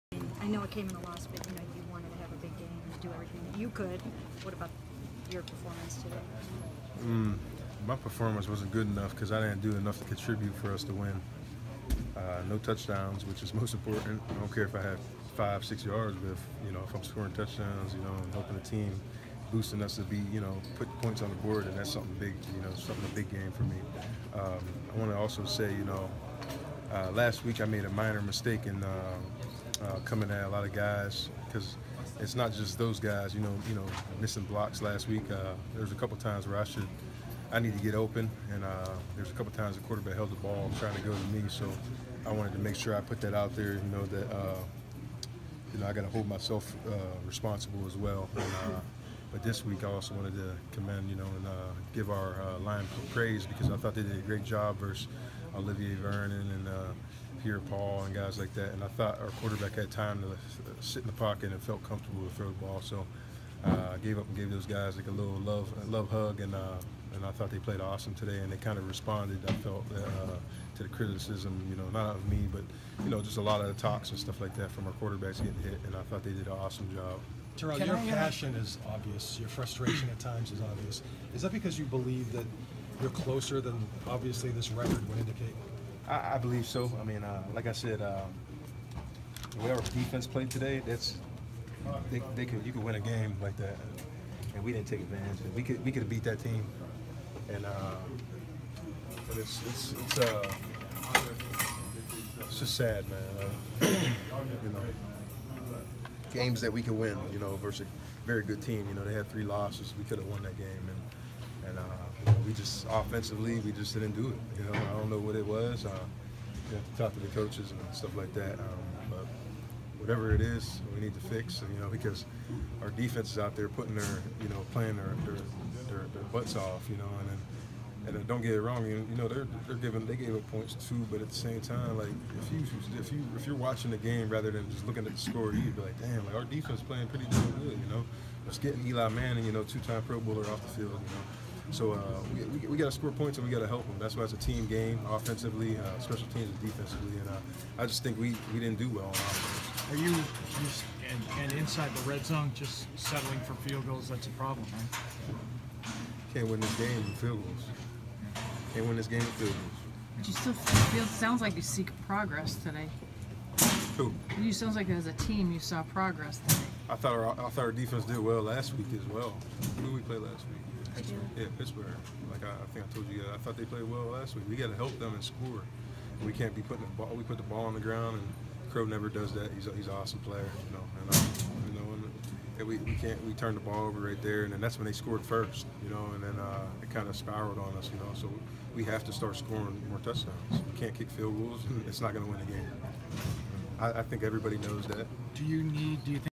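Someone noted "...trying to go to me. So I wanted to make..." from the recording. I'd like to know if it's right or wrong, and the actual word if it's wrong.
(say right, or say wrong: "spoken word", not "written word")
right.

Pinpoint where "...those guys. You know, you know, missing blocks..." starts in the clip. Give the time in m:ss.
0:32.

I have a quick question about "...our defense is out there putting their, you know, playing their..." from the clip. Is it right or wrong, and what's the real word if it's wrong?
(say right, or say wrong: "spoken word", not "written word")
right.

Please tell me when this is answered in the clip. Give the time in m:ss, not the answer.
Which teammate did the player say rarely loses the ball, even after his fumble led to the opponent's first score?
2:58.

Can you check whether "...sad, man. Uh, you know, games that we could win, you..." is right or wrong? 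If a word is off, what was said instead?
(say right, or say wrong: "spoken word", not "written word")
right.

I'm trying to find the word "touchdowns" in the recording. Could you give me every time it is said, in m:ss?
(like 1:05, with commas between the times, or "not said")
0:12, 0:17, 3:09.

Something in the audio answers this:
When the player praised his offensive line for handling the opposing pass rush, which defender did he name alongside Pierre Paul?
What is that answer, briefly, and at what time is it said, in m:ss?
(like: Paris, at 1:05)
Olivier Vernon, at 0:55.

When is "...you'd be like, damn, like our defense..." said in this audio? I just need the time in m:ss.
2:15.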